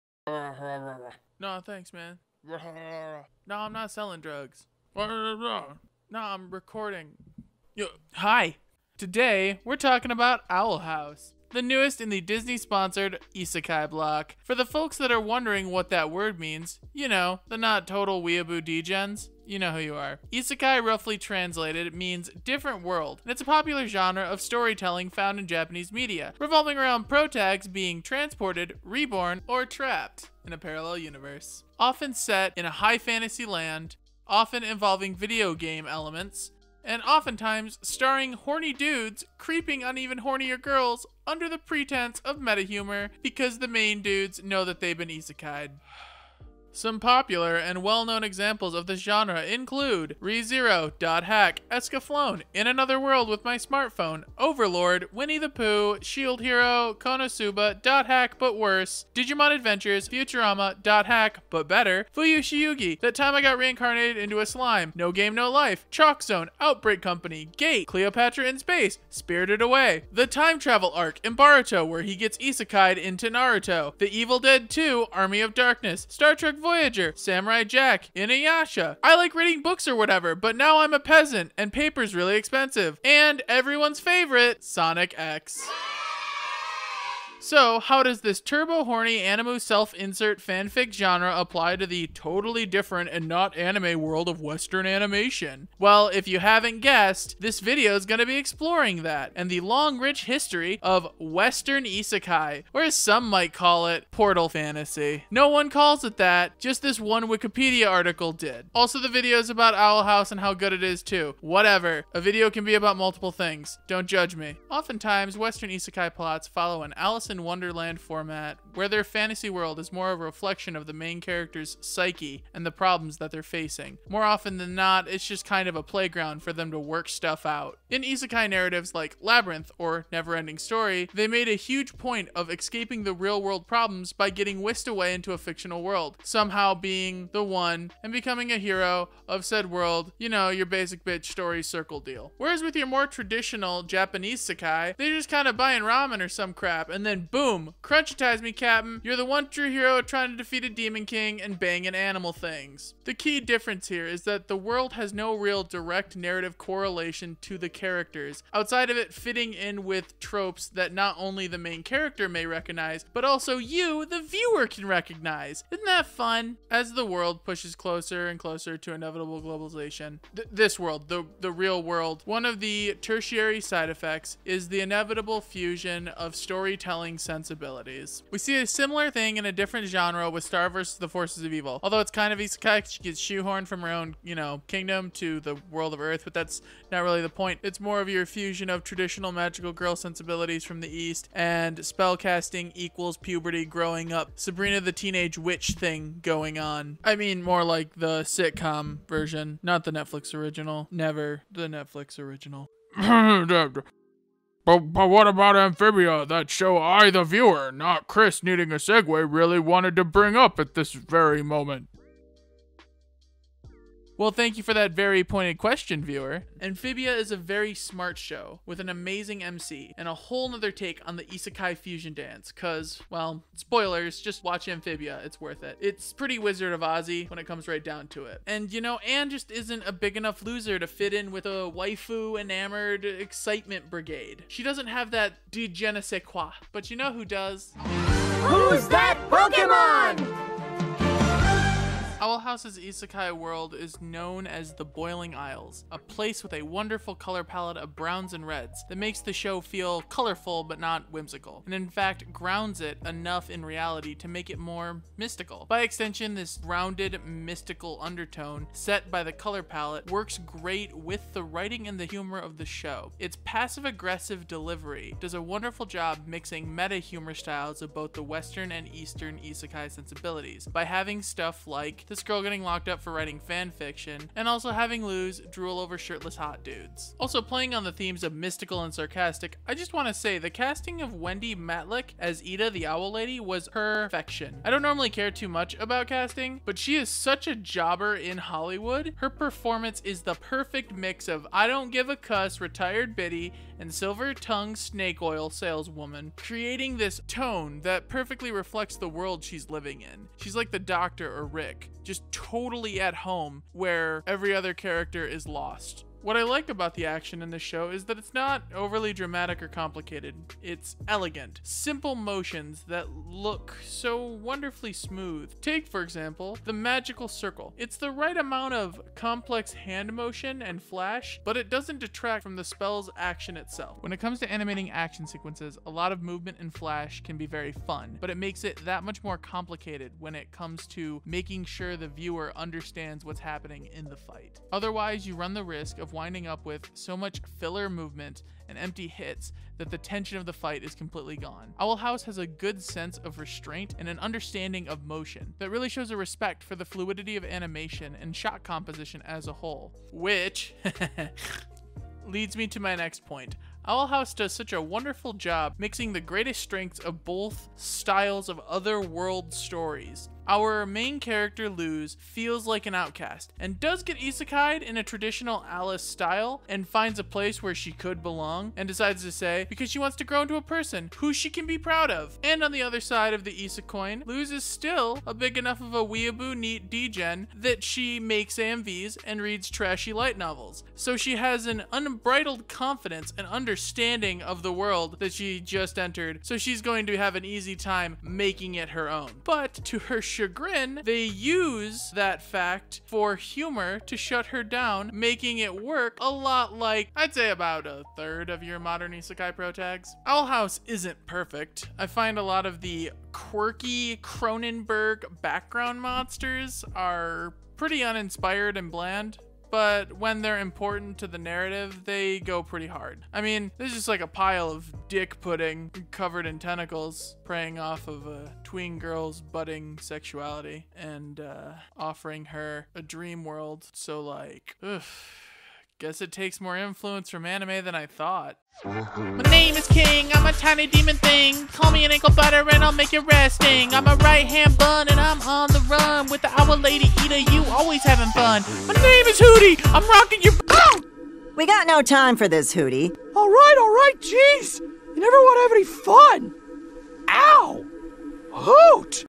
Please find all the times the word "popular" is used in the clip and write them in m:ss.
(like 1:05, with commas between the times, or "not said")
0:23, 0:47.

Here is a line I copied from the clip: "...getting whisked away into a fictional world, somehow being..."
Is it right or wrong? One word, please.
right.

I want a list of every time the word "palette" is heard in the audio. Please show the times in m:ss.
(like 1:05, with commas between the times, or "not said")
4:07, 4:19.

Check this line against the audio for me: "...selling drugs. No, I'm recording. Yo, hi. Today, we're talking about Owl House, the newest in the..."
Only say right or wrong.
right.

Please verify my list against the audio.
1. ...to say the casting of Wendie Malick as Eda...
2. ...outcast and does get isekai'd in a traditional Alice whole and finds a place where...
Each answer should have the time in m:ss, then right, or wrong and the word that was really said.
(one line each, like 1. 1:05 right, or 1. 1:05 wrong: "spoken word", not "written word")
1. 4:40 right
2. 6:02 wrong: "style", not "whole".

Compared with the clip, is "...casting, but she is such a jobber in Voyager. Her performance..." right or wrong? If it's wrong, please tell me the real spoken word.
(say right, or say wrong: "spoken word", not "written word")
wrong: "Hollywood", not "Voyager".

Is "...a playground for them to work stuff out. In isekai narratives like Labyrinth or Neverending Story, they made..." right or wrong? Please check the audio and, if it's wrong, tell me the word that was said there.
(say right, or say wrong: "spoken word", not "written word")
right.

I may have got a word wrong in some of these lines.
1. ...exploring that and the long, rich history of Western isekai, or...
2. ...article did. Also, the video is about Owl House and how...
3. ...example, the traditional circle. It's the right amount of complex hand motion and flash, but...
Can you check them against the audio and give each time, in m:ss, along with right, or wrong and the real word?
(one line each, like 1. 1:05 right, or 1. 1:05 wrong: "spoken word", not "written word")
1. 1:38 right
2. 1:47 right
3. 5:16 wrong: "magical", not "traditional".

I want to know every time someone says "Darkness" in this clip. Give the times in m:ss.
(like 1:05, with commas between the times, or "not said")
1:15.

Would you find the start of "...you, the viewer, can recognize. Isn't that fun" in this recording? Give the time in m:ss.
2:43.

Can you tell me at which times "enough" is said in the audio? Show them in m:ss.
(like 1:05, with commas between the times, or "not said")
3:50, 4:13, 6:15.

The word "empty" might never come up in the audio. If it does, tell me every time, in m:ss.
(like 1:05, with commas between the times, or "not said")
5:38.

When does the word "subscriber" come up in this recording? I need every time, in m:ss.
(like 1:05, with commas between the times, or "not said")
not said.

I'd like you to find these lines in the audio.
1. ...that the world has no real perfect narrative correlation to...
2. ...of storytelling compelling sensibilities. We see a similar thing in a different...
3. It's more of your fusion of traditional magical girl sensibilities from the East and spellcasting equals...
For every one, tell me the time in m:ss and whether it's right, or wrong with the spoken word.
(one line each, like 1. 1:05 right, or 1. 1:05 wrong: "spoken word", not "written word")
1. 2:34 wrong: "direct", not "perfect"
2. 2:56 right
3. 3:07 right.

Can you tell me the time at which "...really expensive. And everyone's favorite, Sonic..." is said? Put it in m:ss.
1:22.